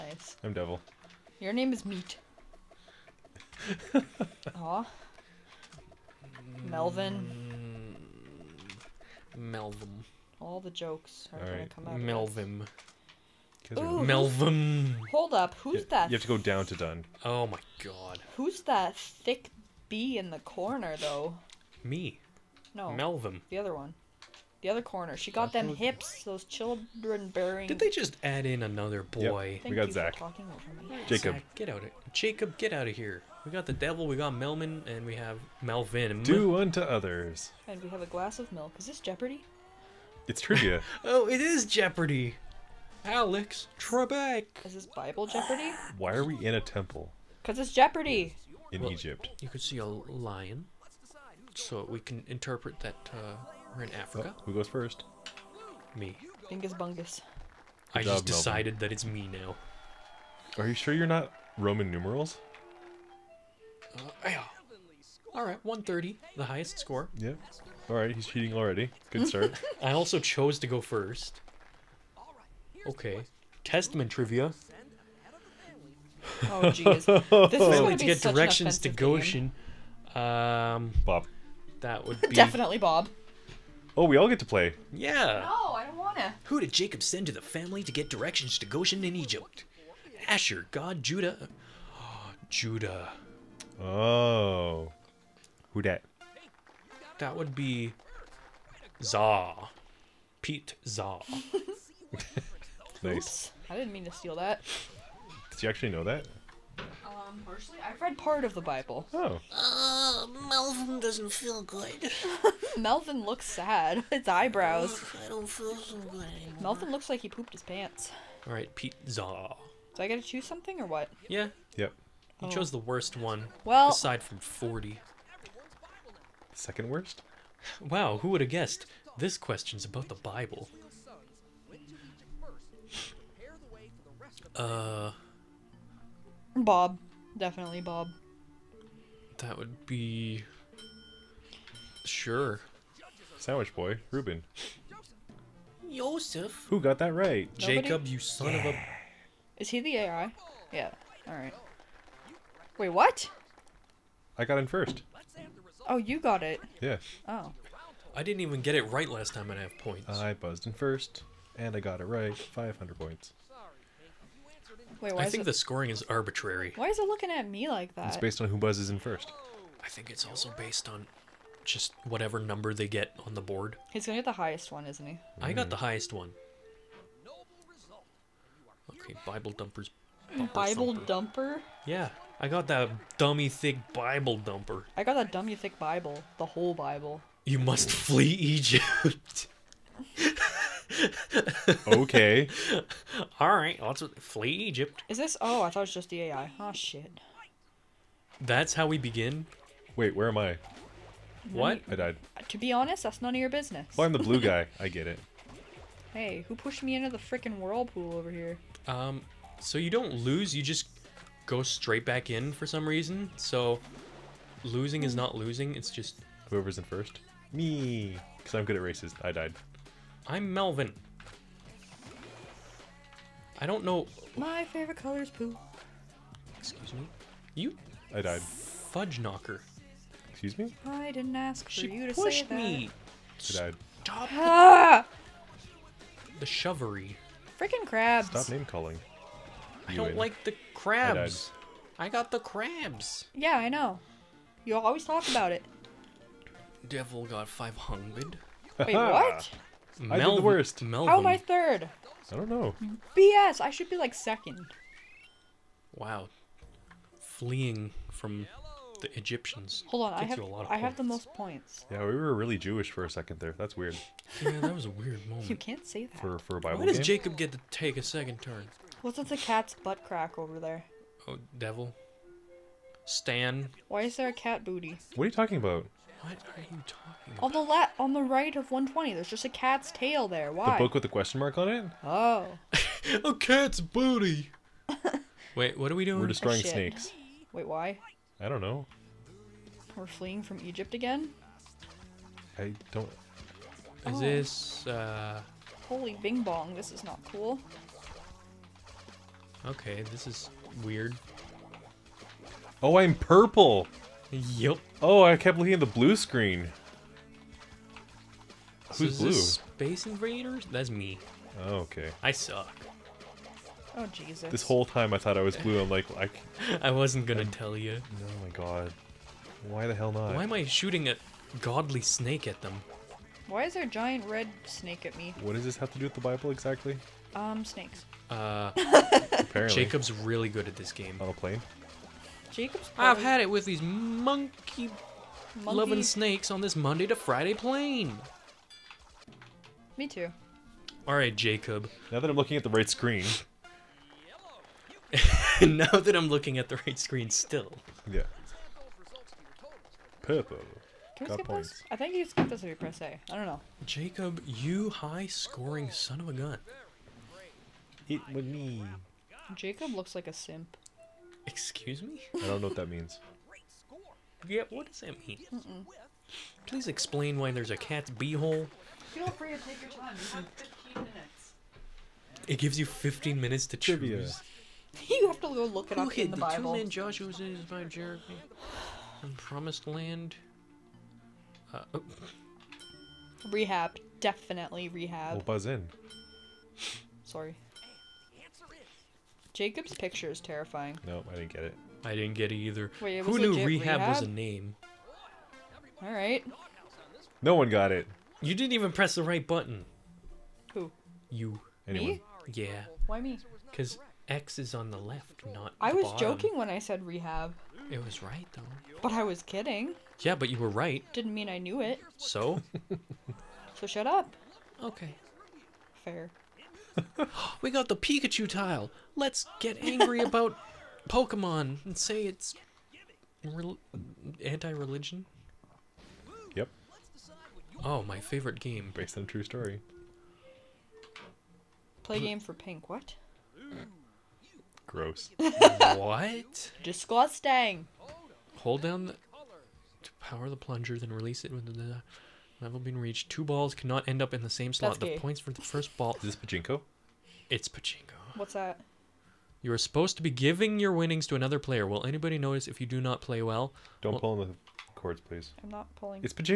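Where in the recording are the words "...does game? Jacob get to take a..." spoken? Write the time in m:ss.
4:26.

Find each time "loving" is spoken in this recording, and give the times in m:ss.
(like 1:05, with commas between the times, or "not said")
5:35.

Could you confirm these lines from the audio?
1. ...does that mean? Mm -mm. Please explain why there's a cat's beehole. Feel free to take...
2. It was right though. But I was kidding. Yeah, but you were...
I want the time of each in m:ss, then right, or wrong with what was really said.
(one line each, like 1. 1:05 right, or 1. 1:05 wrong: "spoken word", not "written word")
1. 6:04 right
2. 6:47 right.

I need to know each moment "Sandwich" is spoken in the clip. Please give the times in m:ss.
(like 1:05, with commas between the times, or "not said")
2:23.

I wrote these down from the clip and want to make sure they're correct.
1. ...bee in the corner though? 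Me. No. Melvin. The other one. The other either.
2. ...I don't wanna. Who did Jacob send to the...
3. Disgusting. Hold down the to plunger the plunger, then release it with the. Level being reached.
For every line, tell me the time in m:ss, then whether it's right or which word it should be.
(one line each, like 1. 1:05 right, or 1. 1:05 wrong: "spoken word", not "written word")
1. 0:19 wrong: "corner", not "either"
2. 1:25 right
3. 7:16 wrong: "power", not "plunger".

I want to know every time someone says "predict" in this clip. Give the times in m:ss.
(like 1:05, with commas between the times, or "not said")
not said.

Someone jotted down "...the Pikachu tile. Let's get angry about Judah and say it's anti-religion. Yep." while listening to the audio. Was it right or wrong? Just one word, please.
wrong.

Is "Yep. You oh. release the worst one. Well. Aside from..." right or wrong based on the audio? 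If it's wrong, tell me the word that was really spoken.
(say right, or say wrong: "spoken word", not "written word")
wrong: "chose", not "release".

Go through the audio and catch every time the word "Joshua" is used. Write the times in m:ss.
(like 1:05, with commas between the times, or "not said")
6:16.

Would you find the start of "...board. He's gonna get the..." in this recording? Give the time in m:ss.
2:53.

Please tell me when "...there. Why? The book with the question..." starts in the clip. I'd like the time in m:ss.
4:40.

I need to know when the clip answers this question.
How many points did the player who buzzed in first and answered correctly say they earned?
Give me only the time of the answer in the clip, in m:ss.
2:42.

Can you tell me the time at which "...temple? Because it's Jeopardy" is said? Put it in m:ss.
0:46.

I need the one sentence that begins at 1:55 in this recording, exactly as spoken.
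I don't feel so good anymore.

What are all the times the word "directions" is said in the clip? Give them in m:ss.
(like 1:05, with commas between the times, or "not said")
1:18, 1:28.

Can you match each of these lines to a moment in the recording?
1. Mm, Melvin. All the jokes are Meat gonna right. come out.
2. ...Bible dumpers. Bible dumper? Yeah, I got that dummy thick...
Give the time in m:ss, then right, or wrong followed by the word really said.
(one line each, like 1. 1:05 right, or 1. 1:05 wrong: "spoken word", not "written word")
1. 0:07 wrong: "All", not "Meat"
2. 2:59 right.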